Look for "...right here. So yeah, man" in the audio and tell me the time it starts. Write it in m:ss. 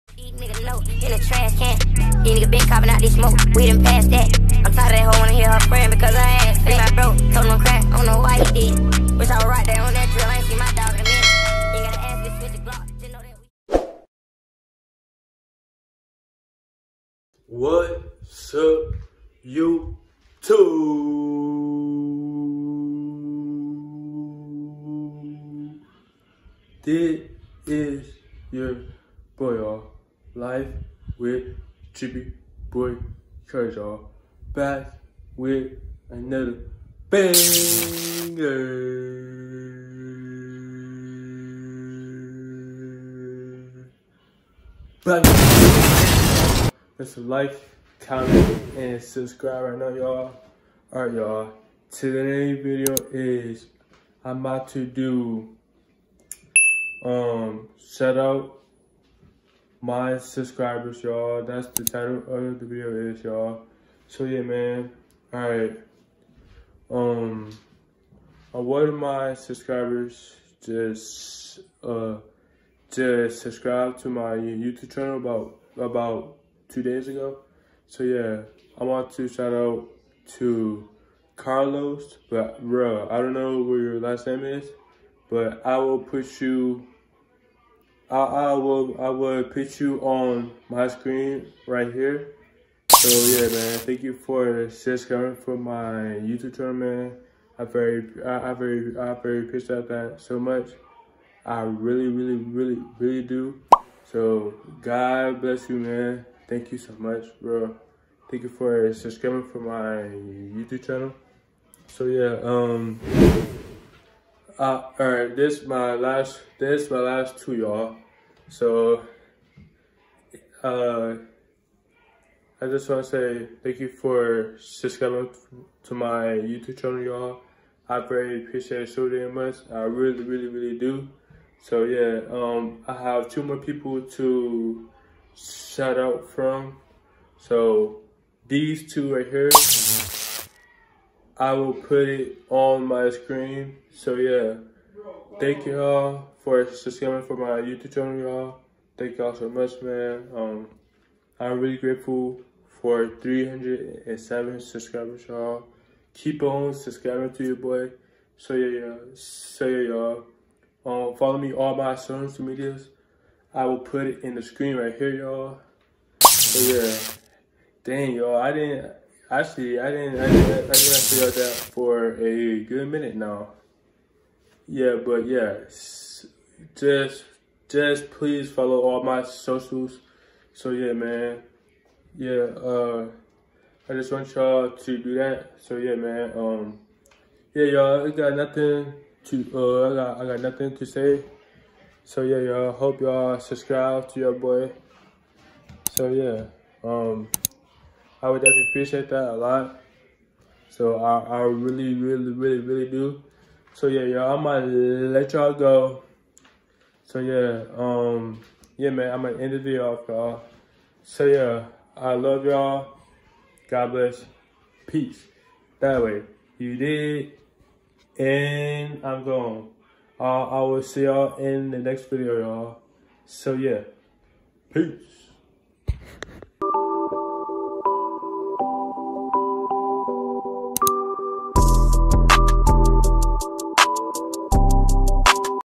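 1:31.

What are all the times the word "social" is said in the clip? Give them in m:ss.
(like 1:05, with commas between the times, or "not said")
2:41, 2:59.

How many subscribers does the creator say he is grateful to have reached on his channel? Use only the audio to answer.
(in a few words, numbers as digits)
307.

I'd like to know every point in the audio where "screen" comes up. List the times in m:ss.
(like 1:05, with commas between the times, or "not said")
1:30, 2:23, 2:44.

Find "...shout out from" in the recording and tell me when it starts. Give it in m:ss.
2:15.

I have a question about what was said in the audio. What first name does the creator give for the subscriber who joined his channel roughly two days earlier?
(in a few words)
Carlos.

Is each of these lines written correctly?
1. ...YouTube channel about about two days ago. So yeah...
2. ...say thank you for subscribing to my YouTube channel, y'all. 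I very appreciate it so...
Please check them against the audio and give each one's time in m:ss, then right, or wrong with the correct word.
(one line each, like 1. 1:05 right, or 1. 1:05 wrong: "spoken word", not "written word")
1. 1:14 right
2. 2:03 right.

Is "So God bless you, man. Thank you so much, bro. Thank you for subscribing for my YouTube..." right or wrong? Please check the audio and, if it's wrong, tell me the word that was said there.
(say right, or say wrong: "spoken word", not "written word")
right.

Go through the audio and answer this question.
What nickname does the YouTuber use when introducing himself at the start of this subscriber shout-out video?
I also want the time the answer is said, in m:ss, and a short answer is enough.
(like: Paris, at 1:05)
Drippy Boi Curtis, at 0:31.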